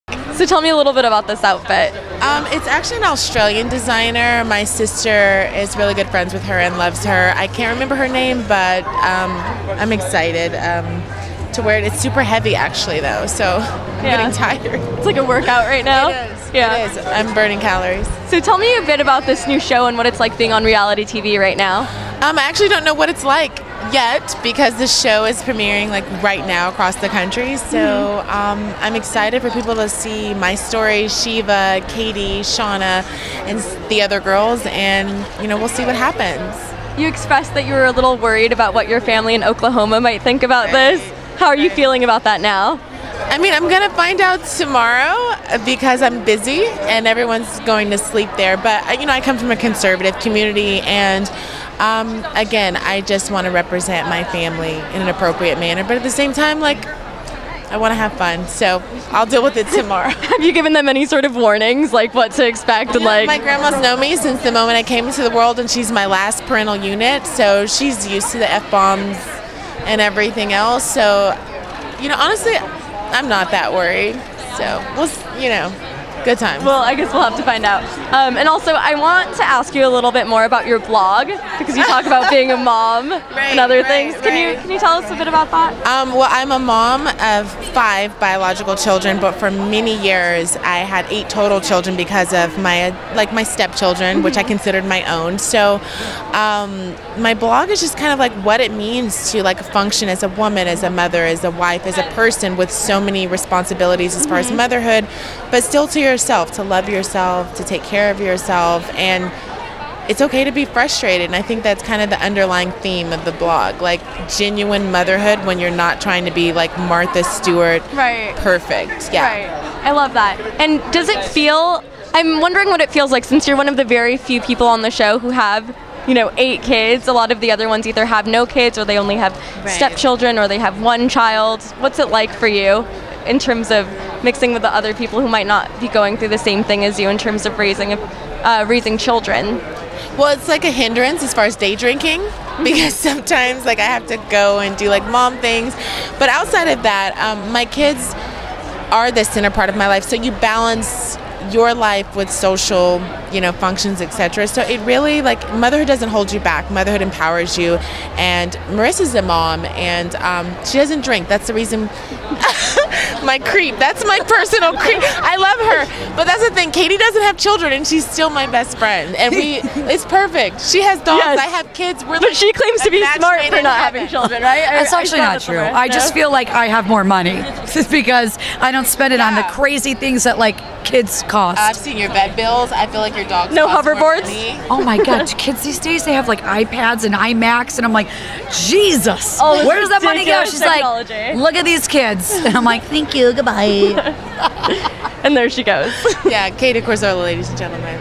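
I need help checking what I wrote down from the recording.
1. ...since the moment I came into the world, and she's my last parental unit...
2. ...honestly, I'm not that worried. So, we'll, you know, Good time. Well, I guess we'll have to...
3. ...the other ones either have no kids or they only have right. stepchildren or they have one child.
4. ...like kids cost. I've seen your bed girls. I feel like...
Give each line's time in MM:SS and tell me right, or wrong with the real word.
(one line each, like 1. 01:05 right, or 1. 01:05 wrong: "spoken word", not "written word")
1. 01:04 right
2. 01:12 right
3. 02:07 right
4. 03:00 wrong: "bills", not "girls".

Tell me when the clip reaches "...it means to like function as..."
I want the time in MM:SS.
01:38.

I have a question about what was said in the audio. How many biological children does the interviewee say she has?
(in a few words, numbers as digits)
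5.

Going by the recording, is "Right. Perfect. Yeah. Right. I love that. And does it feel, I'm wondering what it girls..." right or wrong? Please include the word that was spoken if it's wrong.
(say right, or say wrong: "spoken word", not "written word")
wrong: "feels", not "girls".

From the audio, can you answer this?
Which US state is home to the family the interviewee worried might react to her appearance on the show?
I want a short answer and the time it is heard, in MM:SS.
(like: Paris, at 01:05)
Oklahoma, at 00:39.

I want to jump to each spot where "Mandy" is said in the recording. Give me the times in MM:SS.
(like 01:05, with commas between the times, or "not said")
not said.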